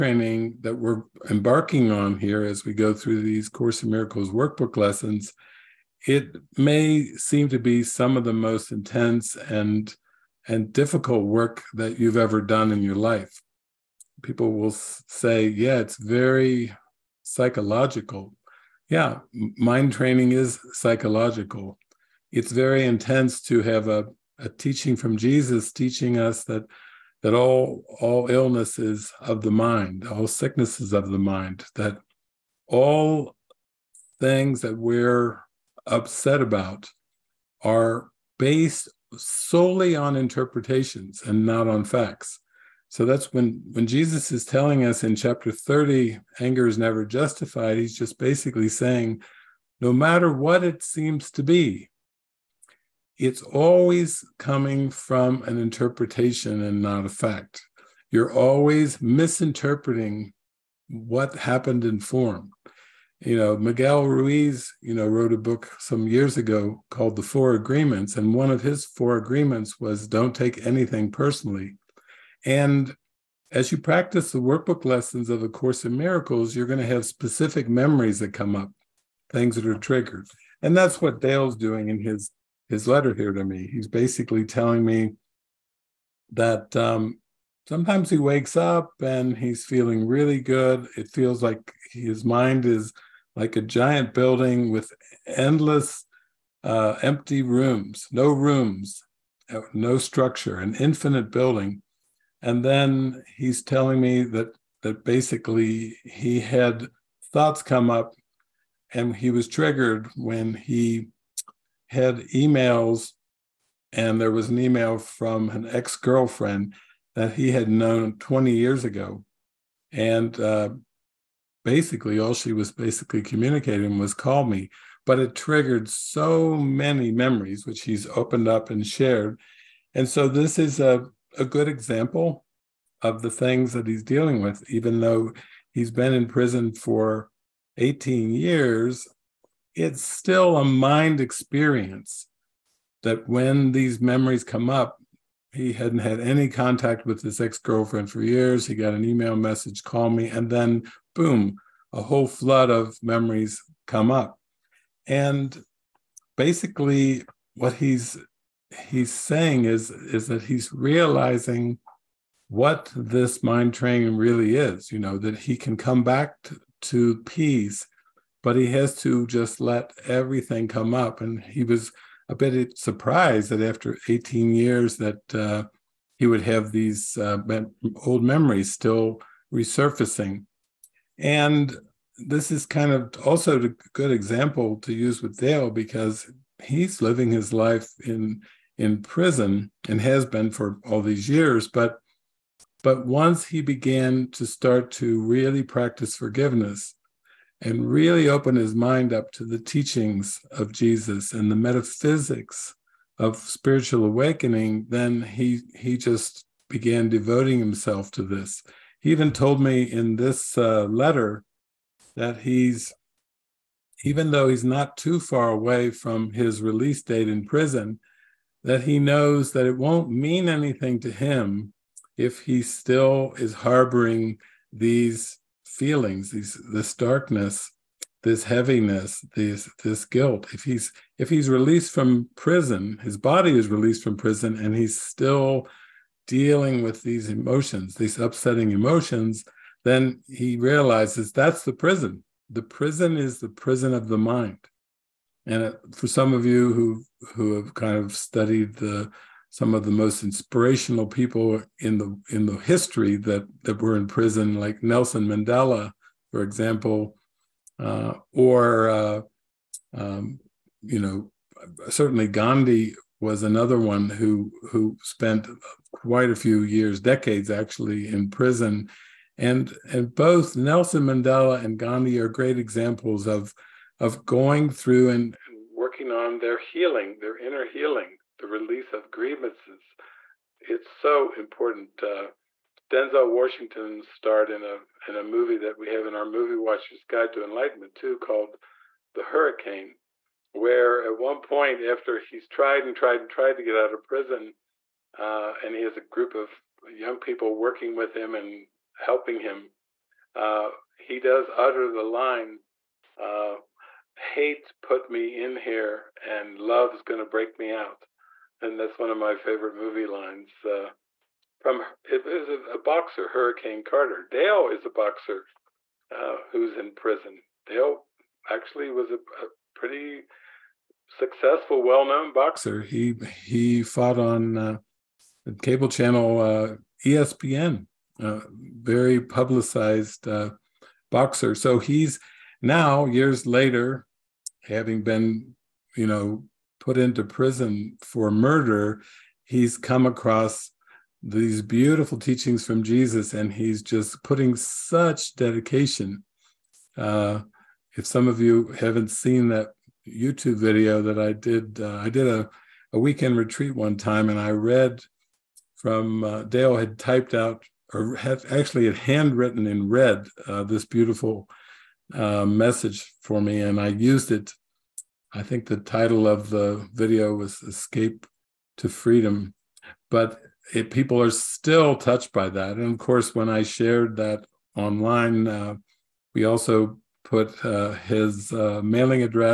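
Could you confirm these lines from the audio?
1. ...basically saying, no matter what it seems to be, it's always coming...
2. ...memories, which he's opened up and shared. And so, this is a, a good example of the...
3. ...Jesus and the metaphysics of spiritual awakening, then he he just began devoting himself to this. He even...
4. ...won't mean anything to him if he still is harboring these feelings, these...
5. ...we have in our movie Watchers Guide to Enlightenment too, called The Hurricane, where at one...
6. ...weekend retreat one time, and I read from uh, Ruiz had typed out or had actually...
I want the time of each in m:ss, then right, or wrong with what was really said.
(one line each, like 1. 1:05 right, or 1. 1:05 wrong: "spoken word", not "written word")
1. 0:48 right
2. 2:07 right
3. 3:20 right
4. 3:39 right
5. 4:45 right
6. 5:52 wrong: "Dale", not "Ruiz".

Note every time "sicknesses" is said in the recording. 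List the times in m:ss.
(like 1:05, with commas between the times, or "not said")
0:30.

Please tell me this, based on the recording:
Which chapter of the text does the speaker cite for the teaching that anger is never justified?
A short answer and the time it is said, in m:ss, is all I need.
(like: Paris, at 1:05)
Chapter 30, at 0:45.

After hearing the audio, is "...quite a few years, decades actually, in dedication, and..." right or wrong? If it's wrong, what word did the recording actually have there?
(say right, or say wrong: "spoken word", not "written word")
wrong: "prison", not "dedication".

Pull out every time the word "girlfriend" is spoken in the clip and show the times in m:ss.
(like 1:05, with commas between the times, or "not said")
1:55, 2:27.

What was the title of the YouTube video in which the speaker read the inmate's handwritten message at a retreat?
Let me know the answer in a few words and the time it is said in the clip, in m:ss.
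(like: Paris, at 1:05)
Escape to Freedom, at 6:07.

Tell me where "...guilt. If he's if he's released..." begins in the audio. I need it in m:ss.
3:50.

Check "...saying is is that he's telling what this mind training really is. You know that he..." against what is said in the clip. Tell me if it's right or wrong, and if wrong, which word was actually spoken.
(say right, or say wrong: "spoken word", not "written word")
wrong: "realizing", not "telling".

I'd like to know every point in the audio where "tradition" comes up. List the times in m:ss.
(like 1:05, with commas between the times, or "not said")
not said.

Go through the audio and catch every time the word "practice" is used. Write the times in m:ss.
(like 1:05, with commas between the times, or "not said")
1:13, 3:15.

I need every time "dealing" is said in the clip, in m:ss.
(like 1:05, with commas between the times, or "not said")
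2:14, 3:56.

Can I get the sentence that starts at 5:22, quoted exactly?
He he fought on uh, the cable channel uh, ESPN, uh, very publicized uh, boxer.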